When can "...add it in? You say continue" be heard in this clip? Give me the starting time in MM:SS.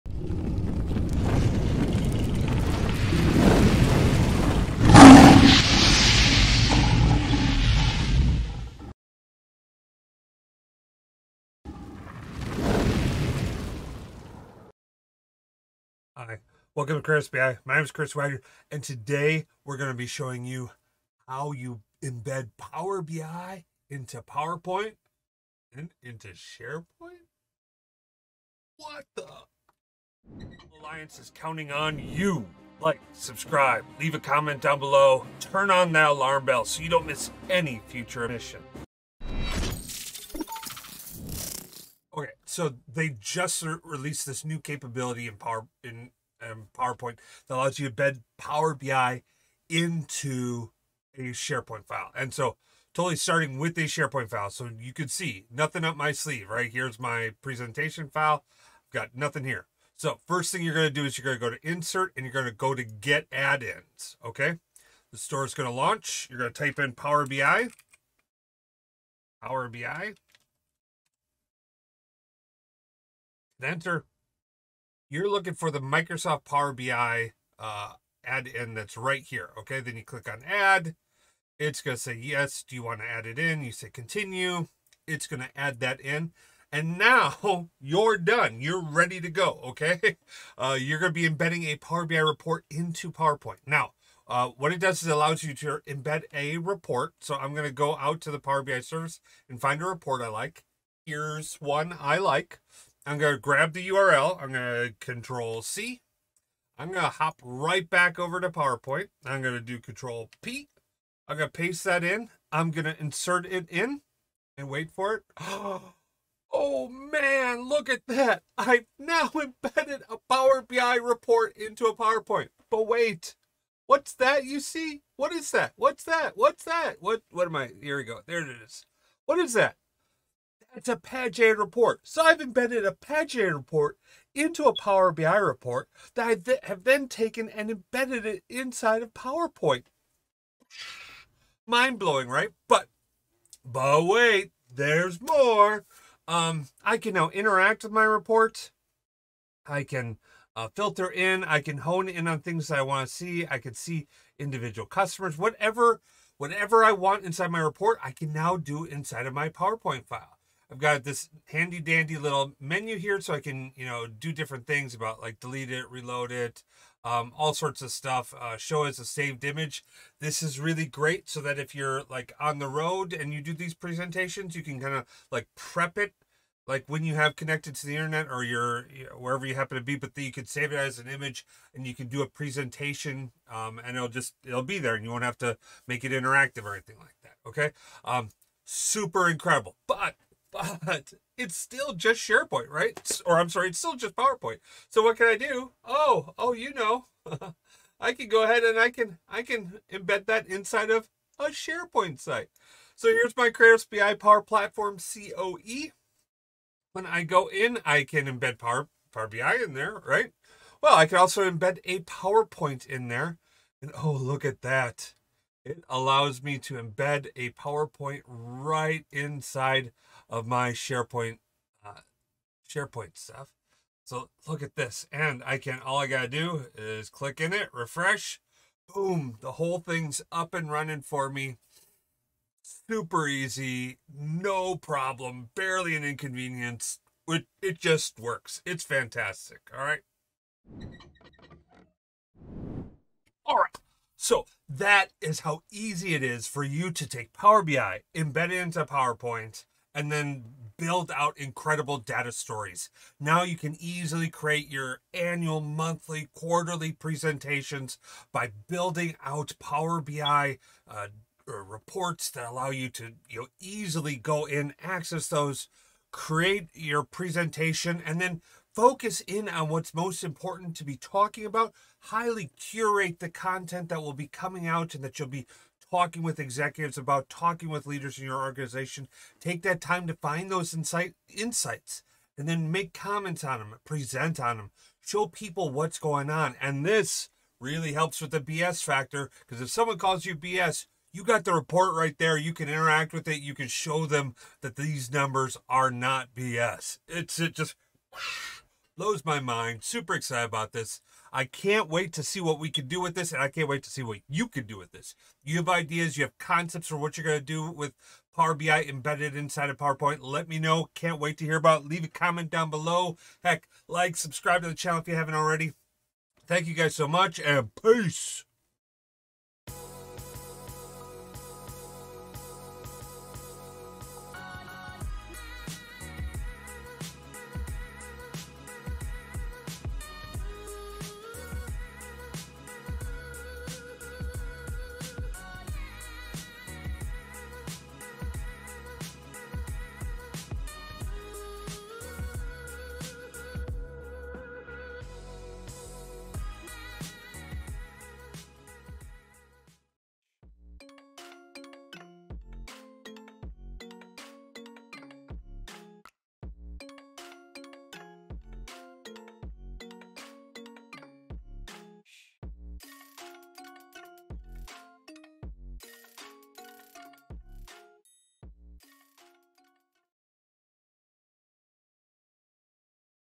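01:23.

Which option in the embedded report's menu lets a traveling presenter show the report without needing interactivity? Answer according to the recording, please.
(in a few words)
Show as a saved image.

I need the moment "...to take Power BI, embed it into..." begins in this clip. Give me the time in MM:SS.
04:06.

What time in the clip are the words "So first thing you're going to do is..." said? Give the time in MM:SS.
00:59.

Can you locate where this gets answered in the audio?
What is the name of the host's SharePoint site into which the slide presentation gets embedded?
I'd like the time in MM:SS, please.
03:23.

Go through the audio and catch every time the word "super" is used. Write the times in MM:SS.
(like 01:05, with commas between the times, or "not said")
03:08, 03:52, 04:59.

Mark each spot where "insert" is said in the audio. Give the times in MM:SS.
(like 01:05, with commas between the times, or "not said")
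01:01, 01:52.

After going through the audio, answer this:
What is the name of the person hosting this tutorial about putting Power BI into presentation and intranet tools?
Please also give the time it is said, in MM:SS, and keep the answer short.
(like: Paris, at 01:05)
Chris Wagner, at 00:17.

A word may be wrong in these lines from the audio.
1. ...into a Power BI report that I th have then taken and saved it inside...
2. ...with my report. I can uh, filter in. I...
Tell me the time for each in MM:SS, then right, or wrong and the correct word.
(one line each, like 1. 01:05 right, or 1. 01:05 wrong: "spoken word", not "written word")
1. 02:14 wrong: "embedded", not "saved"
2. 02:27 right.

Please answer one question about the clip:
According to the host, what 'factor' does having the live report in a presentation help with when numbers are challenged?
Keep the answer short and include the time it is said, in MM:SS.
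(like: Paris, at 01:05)
The BS factor, at 04:48.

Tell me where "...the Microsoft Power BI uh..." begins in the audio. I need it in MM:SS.
01:15.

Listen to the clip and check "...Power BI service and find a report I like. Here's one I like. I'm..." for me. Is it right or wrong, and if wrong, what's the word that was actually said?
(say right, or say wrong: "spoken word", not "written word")
right.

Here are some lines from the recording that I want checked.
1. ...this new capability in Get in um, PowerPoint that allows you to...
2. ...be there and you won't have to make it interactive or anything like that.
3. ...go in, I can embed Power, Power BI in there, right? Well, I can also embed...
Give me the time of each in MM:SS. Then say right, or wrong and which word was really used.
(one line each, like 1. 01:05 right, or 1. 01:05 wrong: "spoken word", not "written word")
1. 00:44 wrong: "Power", not "Get"
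2. 03:04 right
3. 03:27 right.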